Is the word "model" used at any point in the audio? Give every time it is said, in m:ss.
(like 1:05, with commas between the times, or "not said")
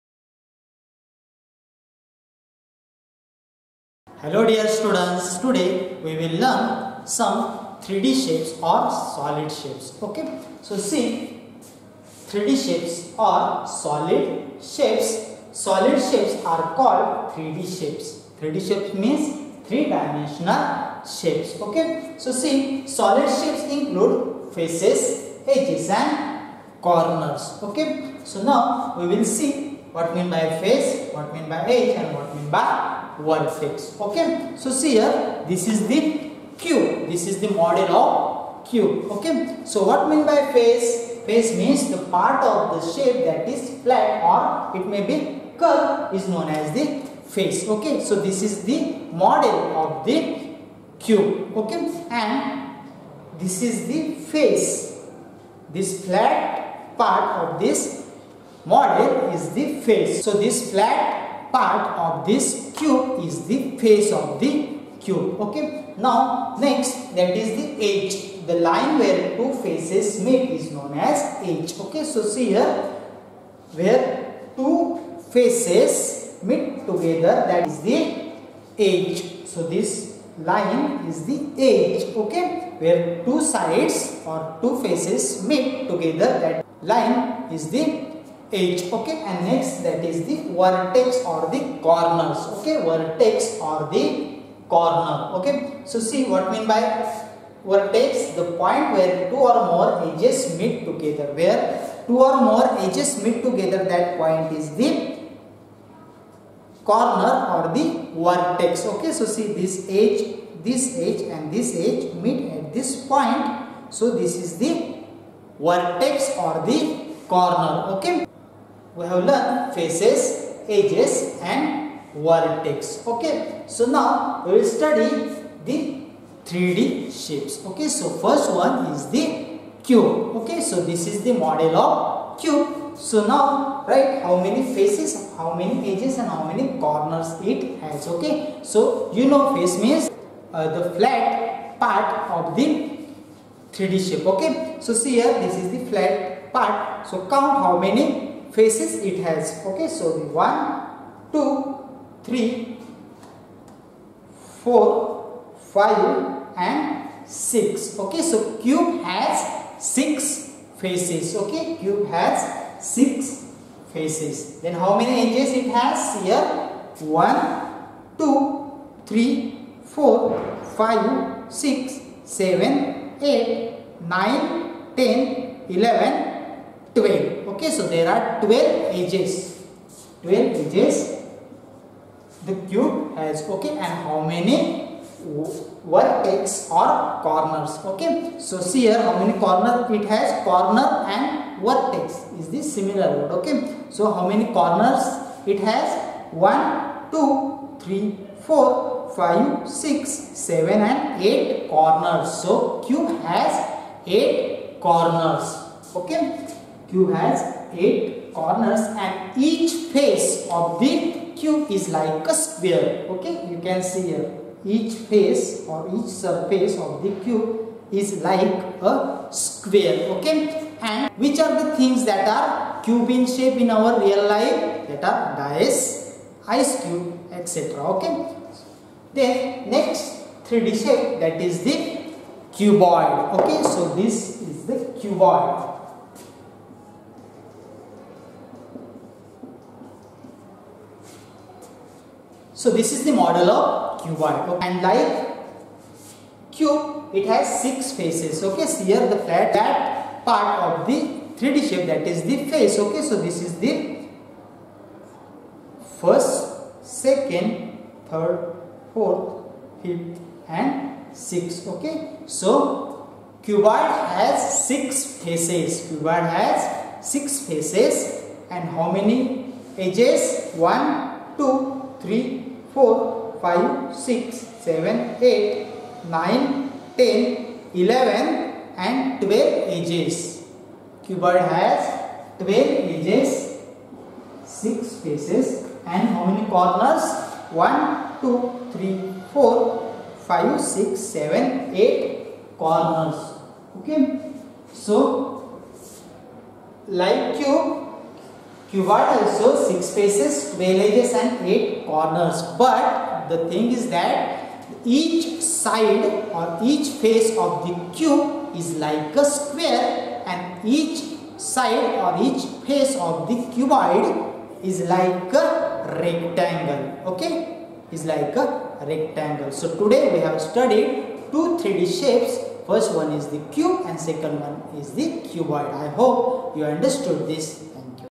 0:37, 0:49, 0:58, 2:11, 4:03.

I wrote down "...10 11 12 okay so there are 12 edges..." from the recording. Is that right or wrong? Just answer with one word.
right.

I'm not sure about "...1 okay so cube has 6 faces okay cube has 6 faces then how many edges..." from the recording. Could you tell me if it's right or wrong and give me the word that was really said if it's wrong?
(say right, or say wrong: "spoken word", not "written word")
wrong: "6", not "1".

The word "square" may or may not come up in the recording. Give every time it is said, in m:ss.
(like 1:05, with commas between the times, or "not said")
3:32, 3:39, 5:09.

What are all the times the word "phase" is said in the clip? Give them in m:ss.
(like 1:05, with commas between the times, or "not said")
0:33.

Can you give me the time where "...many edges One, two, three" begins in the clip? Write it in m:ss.
4:28.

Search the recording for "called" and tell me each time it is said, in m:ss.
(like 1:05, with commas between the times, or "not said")
0:16.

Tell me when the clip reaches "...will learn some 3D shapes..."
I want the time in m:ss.
0:06.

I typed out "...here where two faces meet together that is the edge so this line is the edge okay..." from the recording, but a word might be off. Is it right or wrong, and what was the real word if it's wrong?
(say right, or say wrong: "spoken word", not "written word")
right.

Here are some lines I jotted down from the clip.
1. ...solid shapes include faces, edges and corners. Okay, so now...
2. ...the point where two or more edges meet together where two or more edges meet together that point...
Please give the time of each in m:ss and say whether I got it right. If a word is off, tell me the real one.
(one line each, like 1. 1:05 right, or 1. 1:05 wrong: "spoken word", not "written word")
1. 0:22 right
2. 1:38 right.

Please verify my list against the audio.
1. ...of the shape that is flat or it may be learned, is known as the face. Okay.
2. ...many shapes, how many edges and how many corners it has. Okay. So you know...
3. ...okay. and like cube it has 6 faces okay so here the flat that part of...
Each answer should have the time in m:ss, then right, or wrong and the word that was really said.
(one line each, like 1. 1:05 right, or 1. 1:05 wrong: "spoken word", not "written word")
1. 0:42 wrong: "curved", not "learned"
2. 2:14 wrong: "faces", not "shapes"
3. 4:04 right.